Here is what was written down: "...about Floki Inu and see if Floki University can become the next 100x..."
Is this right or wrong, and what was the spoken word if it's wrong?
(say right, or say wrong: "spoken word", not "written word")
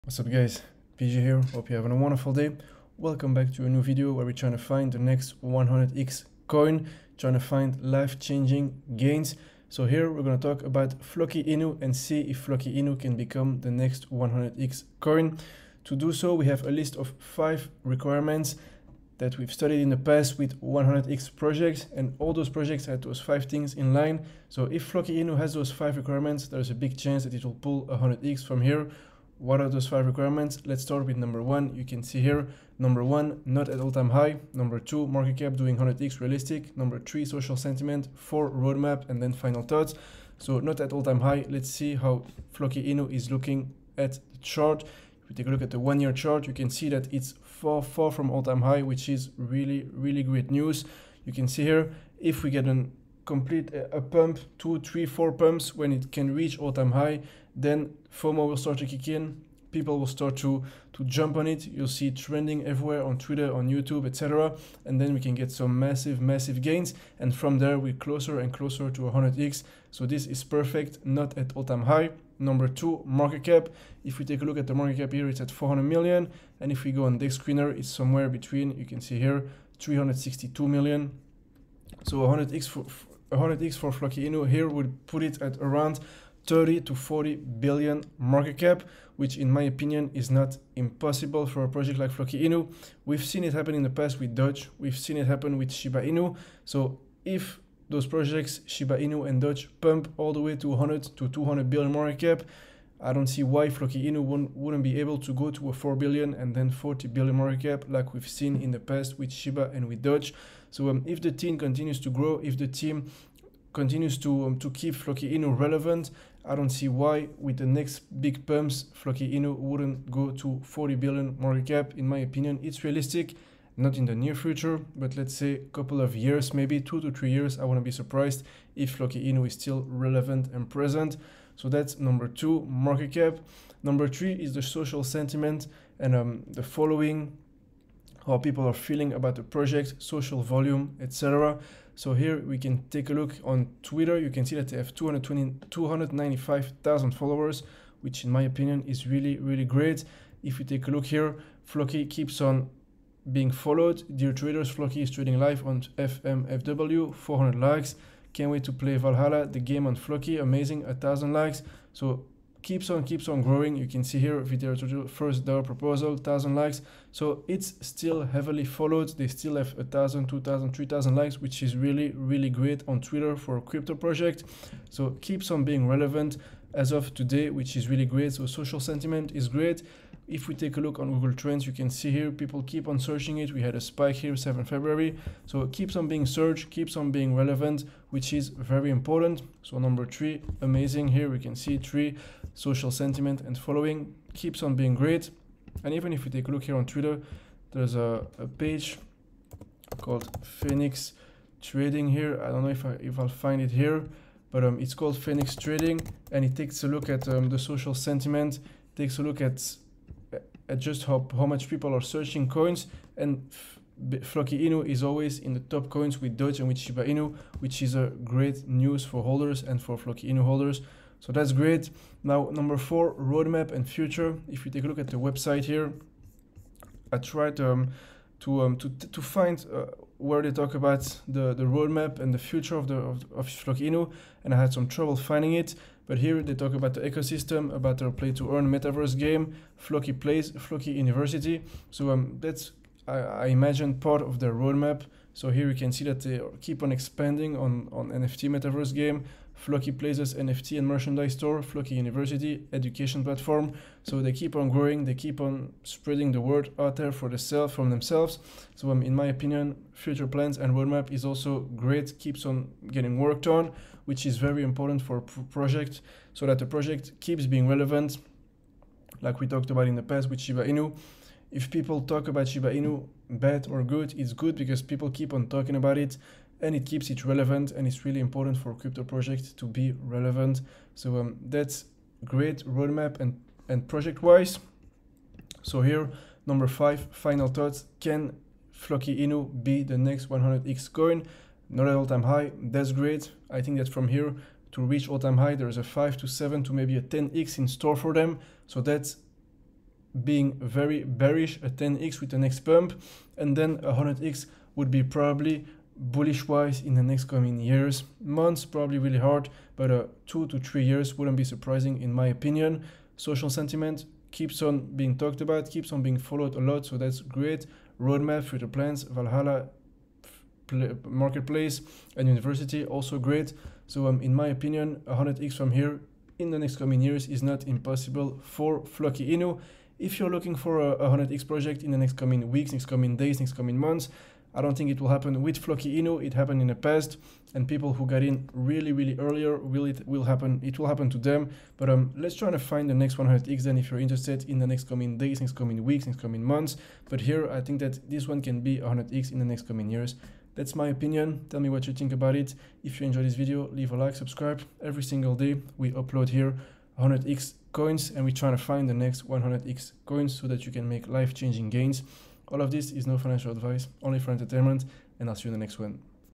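wrong: "Inu", not "University".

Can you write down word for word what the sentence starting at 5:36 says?
It happened in the past, and people who got in really, really earlier will it will happen.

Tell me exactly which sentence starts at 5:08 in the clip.
Months probably really hard, but uh, two to three years wouldn't be surprising in my opinion.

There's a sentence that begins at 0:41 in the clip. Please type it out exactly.
Let's see how Floki Inu is looking at the chart.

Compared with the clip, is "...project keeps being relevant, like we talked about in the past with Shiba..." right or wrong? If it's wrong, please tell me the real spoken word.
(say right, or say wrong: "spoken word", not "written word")
right.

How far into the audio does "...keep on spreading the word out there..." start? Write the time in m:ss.
4:15.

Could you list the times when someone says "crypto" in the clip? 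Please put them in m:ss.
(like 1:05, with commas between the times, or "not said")
2:53, 4:38.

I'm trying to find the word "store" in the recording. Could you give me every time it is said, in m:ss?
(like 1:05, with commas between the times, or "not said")
4:11, 4:57.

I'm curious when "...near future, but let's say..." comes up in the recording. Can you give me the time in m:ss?
2:04.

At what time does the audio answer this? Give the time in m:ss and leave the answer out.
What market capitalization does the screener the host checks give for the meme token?
1:19.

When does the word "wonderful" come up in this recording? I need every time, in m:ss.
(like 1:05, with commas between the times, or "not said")
0:01.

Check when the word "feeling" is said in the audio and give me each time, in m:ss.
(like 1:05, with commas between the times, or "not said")
2:18.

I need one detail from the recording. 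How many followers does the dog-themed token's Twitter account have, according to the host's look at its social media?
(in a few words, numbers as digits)
295,000.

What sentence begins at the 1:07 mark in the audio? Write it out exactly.
And from there, we're closer and closer to 100x.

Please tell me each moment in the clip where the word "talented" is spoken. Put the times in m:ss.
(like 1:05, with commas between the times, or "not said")
not said.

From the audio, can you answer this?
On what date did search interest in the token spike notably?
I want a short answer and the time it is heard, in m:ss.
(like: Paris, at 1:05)
7 February, at 3:04.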